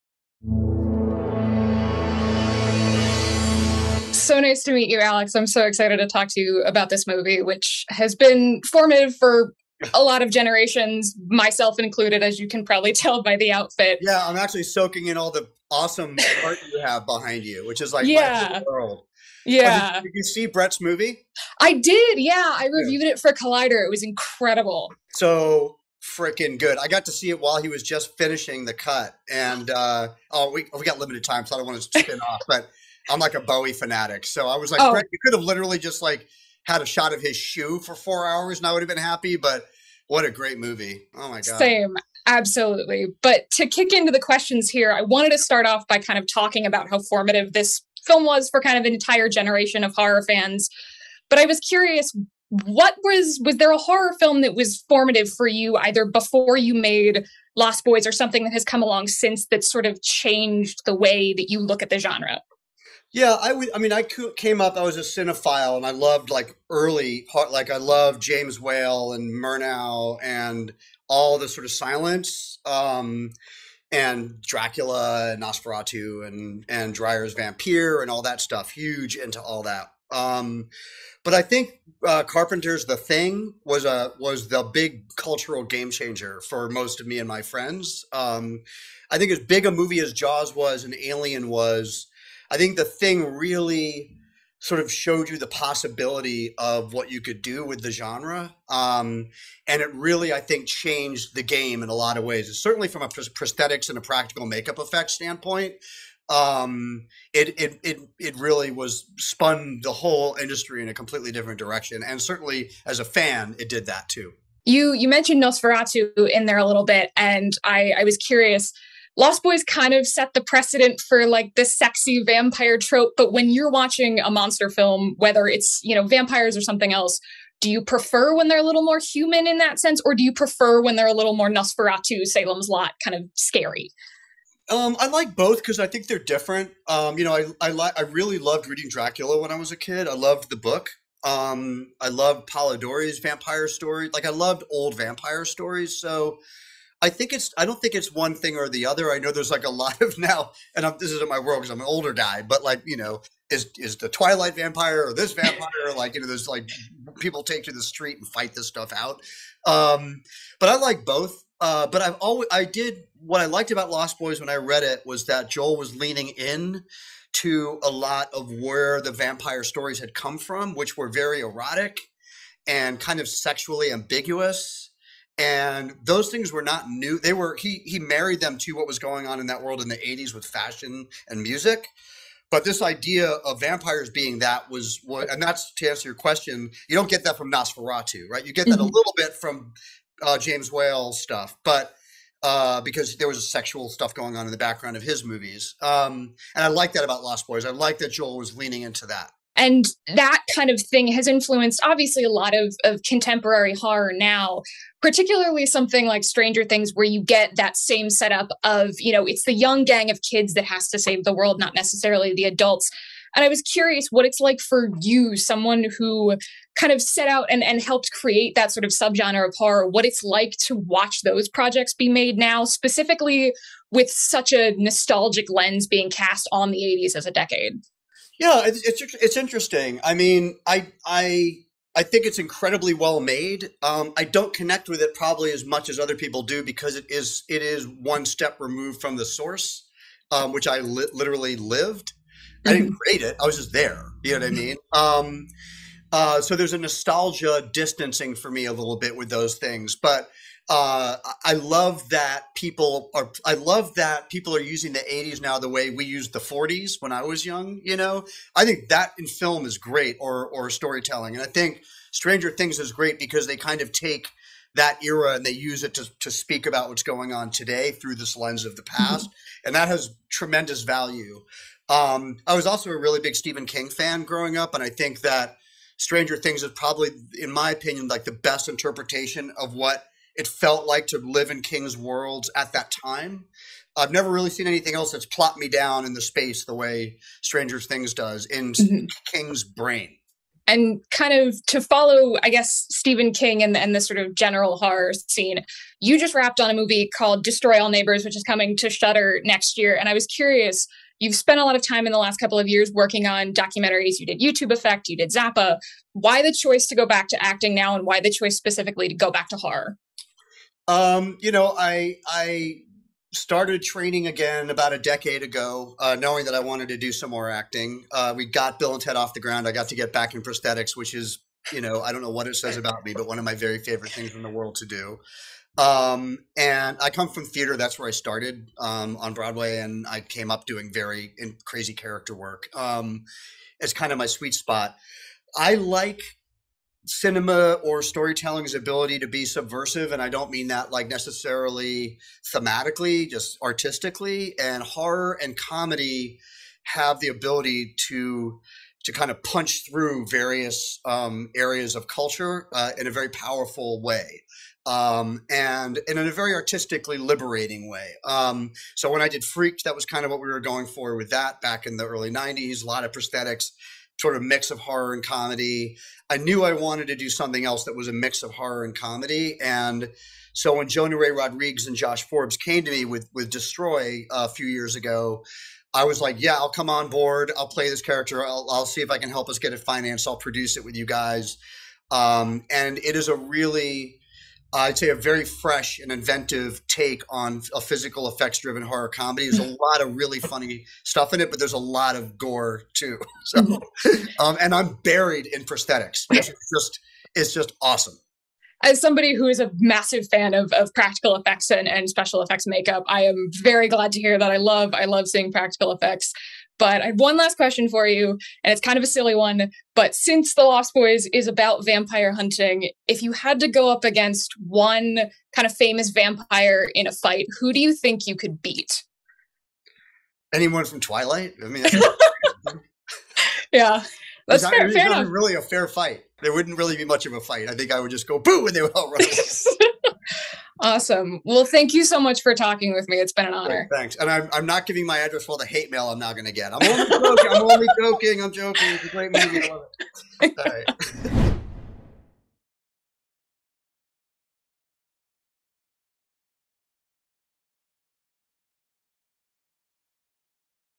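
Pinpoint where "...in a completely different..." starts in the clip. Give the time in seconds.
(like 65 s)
110 s.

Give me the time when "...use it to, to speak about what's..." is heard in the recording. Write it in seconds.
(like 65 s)
265 s.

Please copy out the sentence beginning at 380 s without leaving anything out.
I'll produce it with you guys.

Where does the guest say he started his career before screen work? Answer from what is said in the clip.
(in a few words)
Broadway.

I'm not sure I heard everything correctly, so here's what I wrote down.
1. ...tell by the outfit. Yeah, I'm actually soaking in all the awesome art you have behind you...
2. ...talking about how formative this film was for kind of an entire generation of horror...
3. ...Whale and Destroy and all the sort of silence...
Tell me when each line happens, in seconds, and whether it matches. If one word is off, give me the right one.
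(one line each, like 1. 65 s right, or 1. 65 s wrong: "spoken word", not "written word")
1. 12 s right
2. 46 s right
3. 68 s wrong: "Murnau", not "Destroy".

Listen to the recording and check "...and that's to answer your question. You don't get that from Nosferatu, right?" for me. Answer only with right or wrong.
right.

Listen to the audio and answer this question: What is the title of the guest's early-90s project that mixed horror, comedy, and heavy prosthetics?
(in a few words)
Freaked.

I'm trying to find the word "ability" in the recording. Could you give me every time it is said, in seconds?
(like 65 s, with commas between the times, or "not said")
338 s, 347 s.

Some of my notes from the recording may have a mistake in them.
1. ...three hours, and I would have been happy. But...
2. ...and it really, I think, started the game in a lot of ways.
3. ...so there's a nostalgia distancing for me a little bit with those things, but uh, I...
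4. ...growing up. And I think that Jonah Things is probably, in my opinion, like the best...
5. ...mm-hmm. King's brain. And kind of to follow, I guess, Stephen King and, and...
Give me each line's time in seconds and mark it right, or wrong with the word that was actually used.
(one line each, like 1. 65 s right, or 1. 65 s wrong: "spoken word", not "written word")
1. 37 s wrong: "four", not "three"
2. 99 s wrong: "changed", not "started"
3. 246 s right
4. 274 s wrong: "Stranger", not "Jonah"
5. 288 s right.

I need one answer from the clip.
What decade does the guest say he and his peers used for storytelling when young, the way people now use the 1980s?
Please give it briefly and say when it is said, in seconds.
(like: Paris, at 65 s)
the '40s, at 256 s.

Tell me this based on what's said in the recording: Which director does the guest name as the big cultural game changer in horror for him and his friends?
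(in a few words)
Carpenter.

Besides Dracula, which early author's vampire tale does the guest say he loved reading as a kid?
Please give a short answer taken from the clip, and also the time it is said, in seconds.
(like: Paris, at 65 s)
Polidori's vampire story, at 142 s.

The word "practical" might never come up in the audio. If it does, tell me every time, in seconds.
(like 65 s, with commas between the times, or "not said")
104 s, 400 s, 405 s.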